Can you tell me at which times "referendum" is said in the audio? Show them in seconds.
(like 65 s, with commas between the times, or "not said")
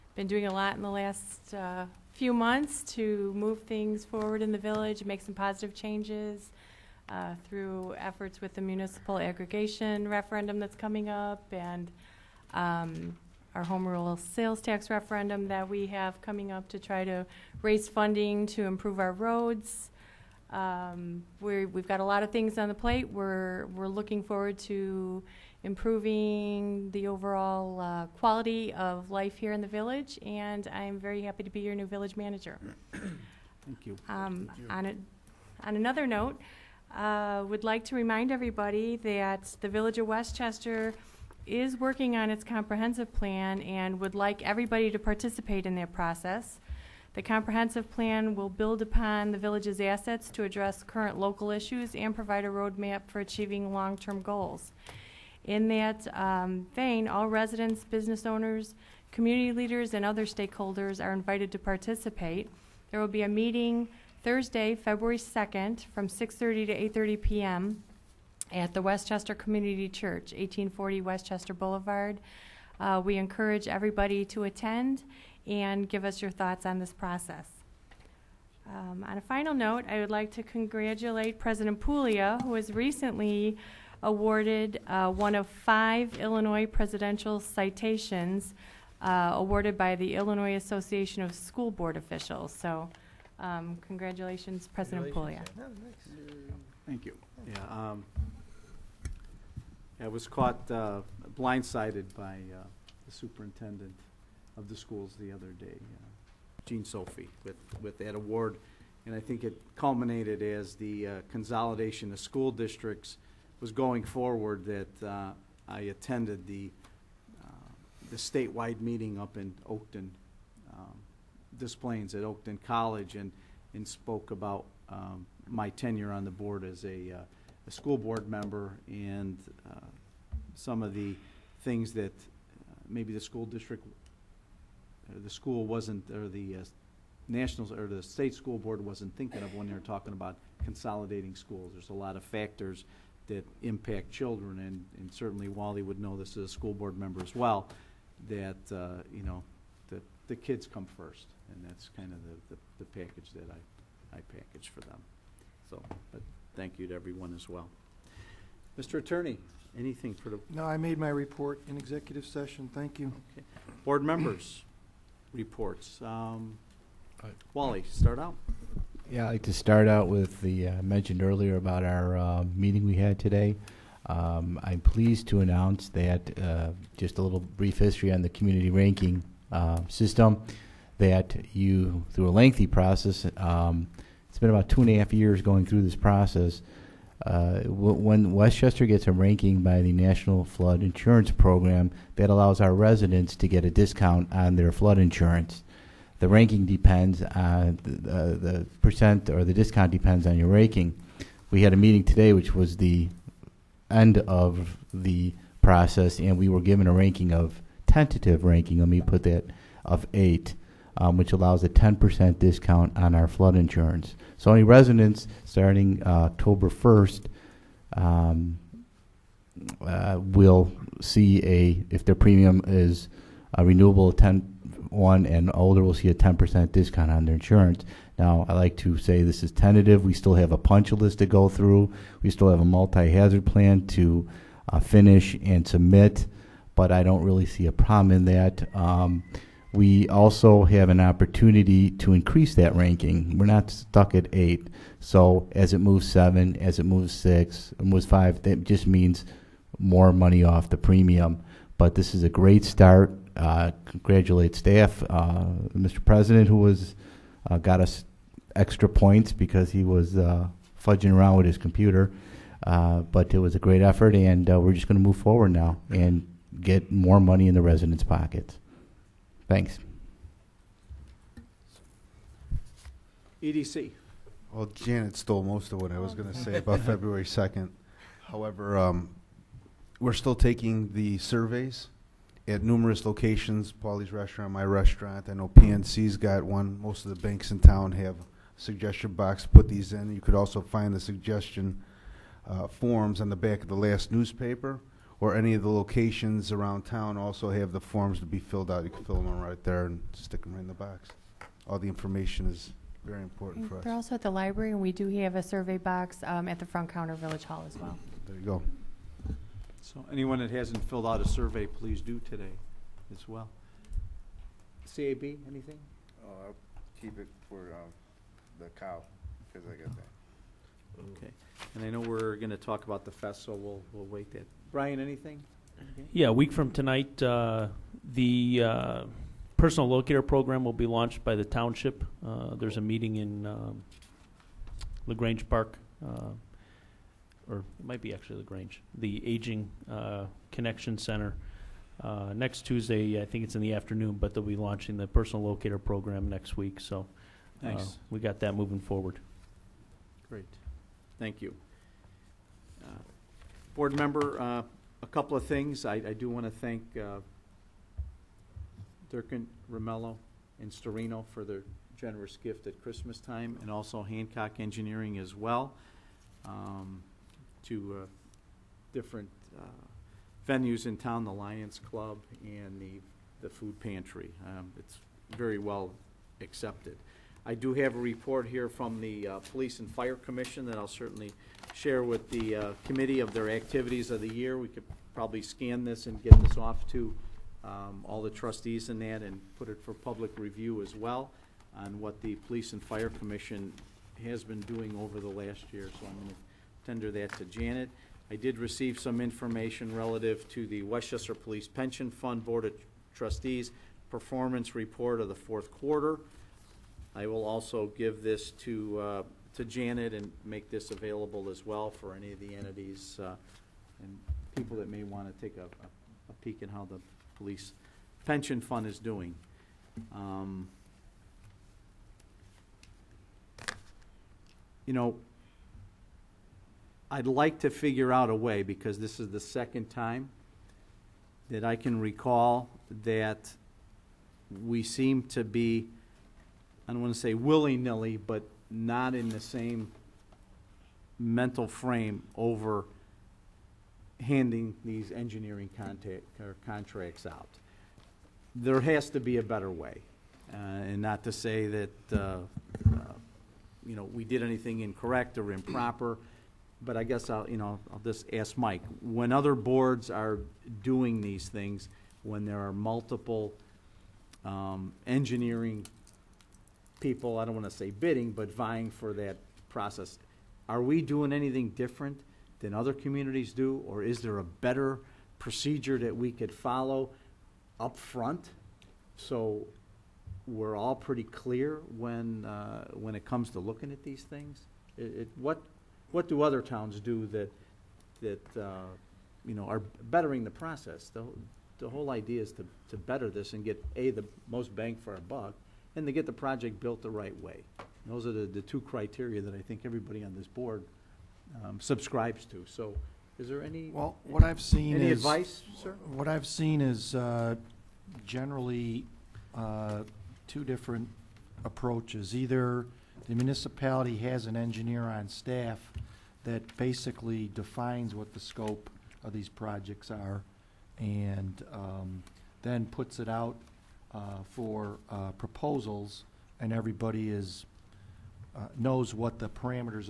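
10 s, 14 s.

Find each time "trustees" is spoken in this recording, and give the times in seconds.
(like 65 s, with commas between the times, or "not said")
388 s, 403 s.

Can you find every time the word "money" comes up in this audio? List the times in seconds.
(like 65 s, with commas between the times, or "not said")
250 s, 267 s.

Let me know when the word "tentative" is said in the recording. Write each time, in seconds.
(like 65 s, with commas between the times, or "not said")
207 s, 229 s.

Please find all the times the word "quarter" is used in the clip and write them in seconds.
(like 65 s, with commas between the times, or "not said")
405 s.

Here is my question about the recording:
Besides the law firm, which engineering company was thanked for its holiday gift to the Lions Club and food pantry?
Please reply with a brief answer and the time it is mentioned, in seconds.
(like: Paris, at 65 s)
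Hancock Engineering, at 364 s.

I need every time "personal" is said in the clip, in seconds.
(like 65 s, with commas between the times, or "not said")
329 s, 345 s.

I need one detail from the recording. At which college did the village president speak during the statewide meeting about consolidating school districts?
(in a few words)
Oakton College.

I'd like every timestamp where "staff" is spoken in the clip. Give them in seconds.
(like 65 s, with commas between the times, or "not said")
254 s, 515 s.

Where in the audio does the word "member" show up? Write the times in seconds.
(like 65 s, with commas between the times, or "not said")
128 s, 146 s, 164 s, 353 s.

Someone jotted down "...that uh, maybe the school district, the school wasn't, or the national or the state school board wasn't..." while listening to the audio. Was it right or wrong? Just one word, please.
right.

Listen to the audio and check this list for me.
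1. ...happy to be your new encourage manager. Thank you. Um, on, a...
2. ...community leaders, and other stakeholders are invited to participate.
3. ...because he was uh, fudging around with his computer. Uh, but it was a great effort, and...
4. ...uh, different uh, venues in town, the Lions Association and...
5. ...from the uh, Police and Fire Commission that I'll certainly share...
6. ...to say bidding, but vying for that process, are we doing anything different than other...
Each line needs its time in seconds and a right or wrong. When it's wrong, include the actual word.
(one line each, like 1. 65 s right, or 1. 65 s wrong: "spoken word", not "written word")
1. 31 s wrong: "village", not "encourage"
2. 59 s right
3. 259 s right
4. 367 s wrong: "Club", not "Association"
5. 378 s right
6. 467 s right.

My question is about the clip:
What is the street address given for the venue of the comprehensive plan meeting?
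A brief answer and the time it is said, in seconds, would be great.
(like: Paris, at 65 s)
1840 Westchester Boulevard, at 70 s.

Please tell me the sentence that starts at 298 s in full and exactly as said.
You can fill them right there and stick them right in the box.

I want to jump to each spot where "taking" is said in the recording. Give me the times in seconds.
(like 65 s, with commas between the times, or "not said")
280 s.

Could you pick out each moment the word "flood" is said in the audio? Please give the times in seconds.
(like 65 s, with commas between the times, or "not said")
190 s, 194 s, 213 s.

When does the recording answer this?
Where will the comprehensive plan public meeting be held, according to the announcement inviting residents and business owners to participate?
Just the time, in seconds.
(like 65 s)
68 s.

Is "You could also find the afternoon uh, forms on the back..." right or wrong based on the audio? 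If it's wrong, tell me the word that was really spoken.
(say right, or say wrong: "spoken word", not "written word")
wrong: "suggestion", not "afternoon".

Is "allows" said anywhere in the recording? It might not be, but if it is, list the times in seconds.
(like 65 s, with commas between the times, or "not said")
192 s, 211 s.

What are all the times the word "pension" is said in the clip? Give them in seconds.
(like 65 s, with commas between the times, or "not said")
401 s, 418 s.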